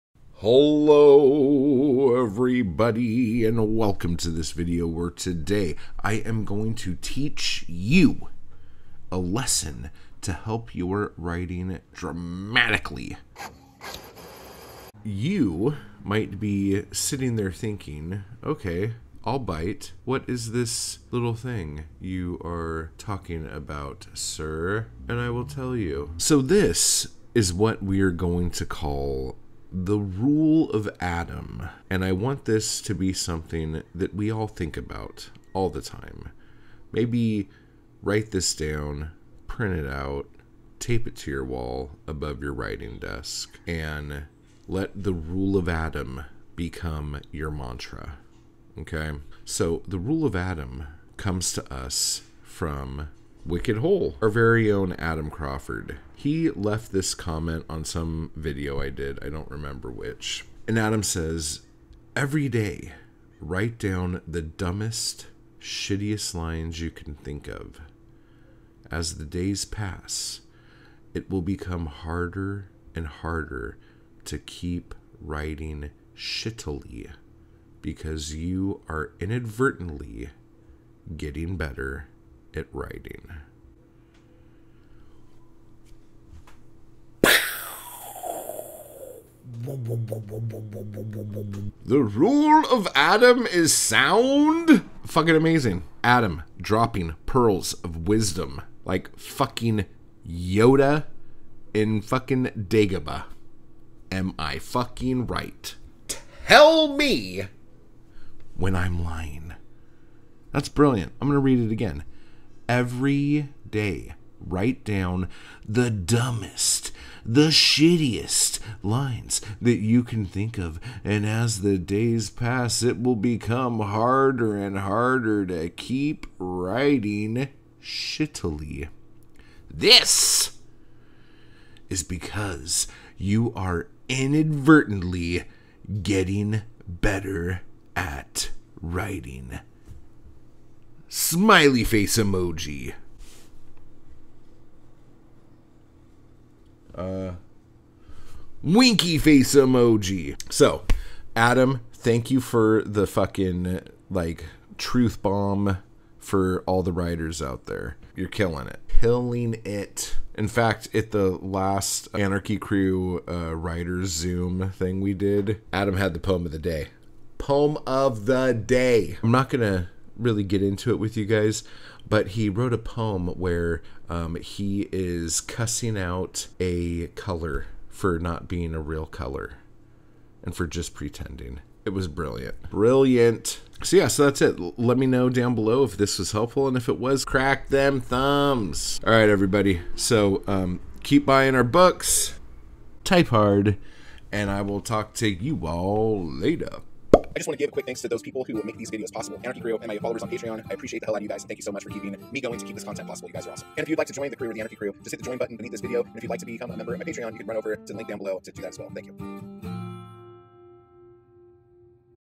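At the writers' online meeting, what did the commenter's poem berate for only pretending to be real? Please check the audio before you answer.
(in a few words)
A color.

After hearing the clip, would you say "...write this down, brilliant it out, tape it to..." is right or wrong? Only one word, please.
wrong.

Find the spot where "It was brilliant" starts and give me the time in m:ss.
3:01.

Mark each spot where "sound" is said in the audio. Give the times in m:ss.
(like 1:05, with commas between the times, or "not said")
1:33.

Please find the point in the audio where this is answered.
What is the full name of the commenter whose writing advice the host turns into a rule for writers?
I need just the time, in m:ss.
0:54.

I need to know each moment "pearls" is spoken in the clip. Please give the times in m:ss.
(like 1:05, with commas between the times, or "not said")
1:37.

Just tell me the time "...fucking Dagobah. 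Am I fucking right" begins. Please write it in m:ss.
1:42.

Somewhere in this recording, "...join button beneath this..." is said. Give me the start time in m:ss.
3:25.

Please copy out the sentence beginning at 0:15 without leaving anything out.
You might be sitting there thinking, okay, I'll bite.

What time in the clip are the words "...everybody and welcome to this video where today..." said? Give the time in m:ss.
0:02.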